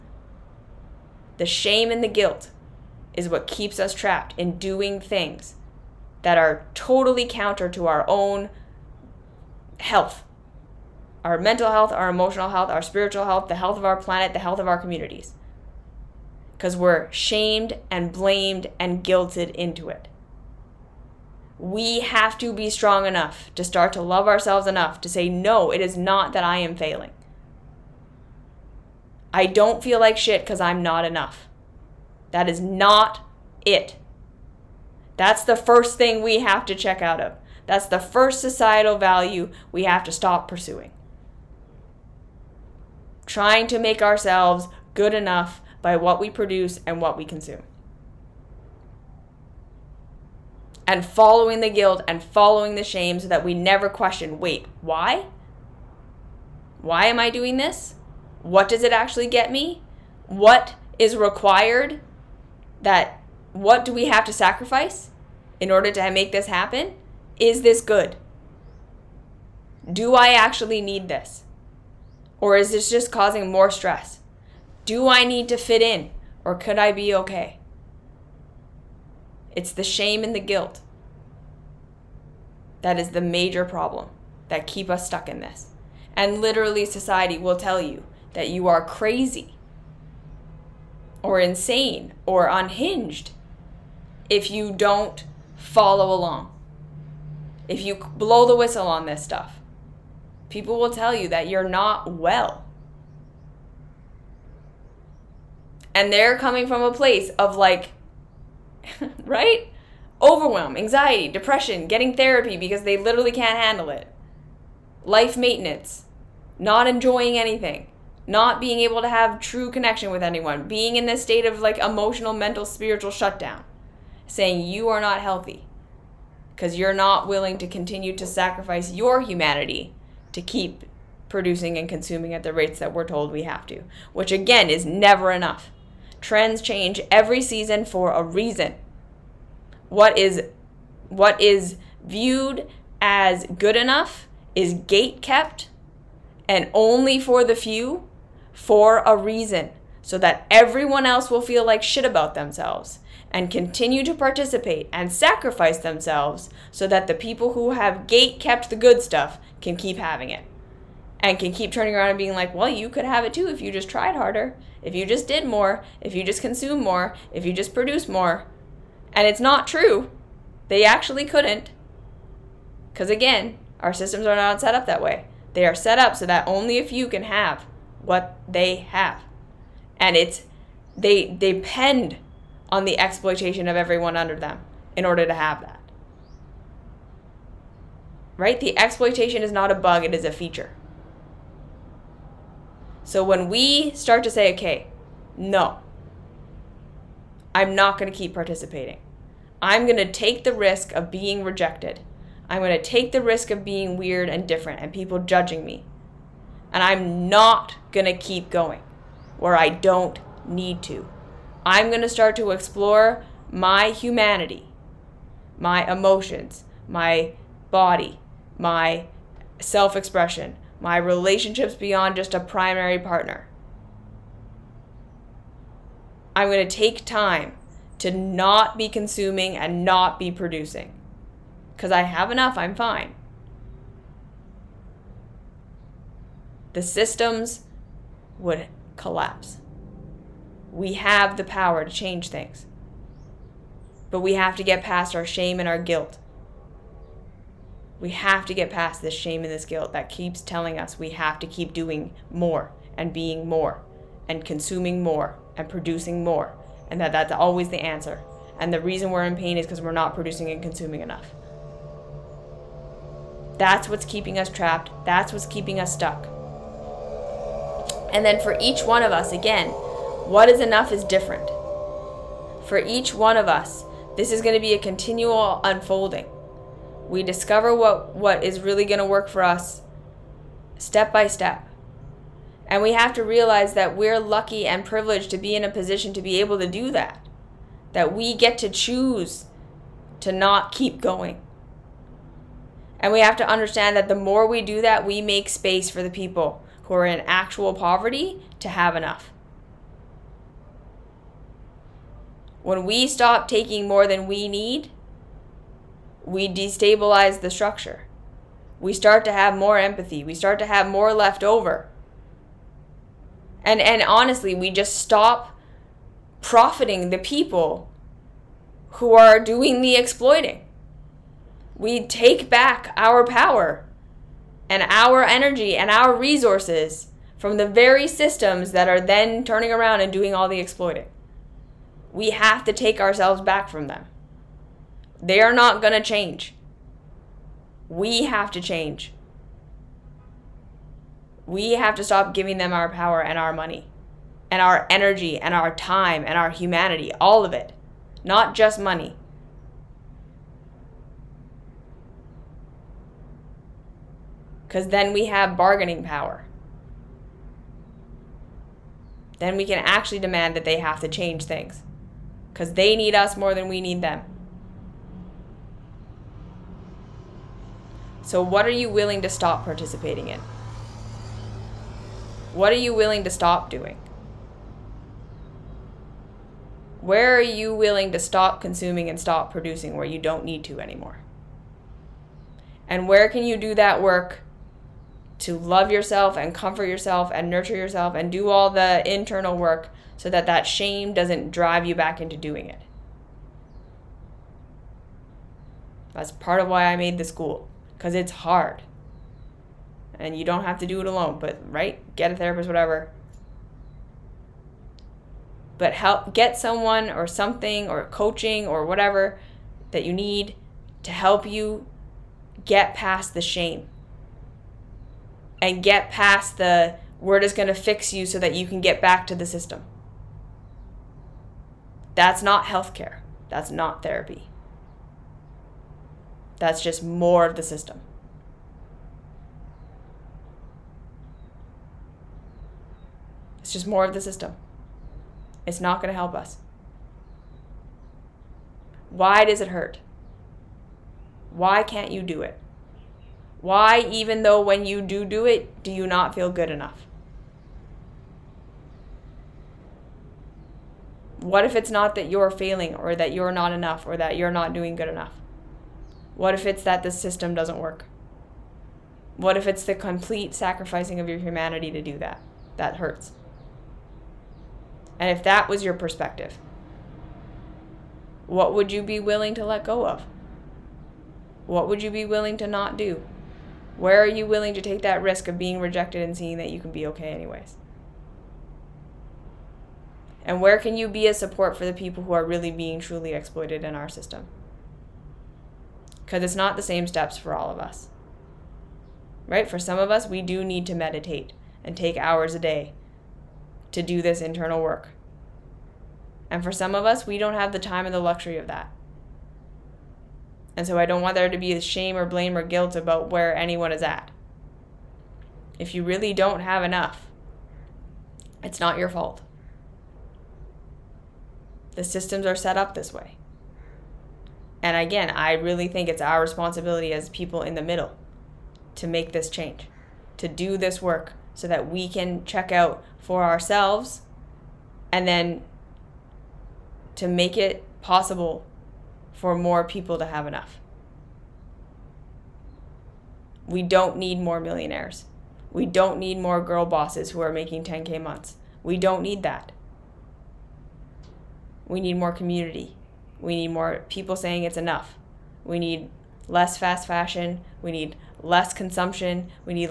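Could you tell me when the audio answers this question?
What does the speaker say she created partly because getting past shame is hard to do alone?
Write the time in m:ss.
6:37.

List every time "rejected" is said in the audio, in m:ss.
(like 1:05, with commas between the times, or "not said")
3:21, 7:55.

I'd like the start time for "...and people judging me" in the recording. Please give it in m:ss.
3:24.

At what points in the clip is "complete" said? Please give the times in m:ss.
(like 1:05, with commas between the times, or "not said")
7:39.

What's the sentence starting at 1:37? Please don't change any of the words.
If you blow the whistle on this stuff, people will tell you that you're not well.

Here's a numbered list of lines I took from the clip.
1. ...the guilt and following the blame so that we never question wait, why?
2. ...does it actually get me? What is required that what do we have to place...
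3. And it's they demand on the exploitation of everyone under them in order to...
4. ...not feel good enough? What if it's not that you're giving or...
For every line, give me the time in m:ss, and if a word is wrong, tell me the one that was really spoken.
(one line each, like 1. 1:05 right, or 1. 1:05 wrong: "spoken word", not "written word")
1. 0:51 wrong: "shame", not "blame"
2. 0:58 wrong: "sacrifice", not "place"
3. 2:59 wrong: "depend", not "demand"
4. 7:26 wrong: "failing", not "giving".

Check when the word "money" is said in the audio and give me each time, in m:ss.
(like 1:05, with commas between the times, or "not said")
5:43, 5:48.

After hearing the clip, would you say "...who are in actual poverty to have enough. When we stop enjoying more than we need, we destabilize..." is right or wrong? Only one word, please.
wrong.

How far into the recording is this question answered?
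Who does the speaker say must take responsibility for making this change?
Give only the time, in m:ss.
8:37.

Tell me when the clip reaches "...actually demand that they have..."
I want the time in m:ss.
5:59.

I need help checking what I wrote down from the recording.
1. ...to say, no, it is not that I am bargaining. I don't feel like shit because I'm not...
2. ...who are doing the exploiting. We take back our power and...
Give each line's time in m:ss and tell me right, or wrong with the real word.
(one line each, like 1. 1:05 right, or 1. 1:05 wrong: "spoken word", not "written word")
1. 0:25 wrong: "failing", not "bargaining"
2. 5:18 right.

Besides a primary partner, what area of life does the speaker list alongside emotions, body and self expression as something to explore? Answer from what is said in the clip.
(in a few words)
relationships.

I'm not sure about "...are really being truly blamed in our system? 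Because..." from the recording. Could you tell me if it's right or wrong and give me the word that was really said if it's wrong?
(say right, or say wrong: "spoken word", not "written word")
wrong: "exploited", not "blamed".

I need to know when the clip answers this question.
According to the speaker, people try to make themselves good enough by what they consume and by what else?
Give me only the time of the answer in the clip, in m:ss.
0:45.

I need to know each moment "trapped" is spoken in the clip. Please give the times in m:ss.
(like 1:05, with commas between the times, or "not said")
0:03, 4:24.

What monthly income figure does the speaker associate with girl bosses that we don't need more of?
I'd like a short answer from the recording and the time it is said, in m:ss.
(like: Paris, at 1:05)
10K, at 8:57.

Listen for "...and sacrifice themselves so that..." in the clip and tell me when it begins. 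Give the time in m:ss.
2:34.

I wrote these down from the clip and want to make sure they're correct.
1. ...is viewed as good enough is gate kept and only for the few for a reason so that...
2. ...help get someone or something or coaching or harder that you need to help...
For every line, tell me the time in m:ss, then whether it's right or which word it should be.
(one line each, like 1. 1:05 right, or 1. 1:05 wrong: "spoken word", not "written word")
1. 2:21 right
2. 6:45 wrong: "whatever", not "harder".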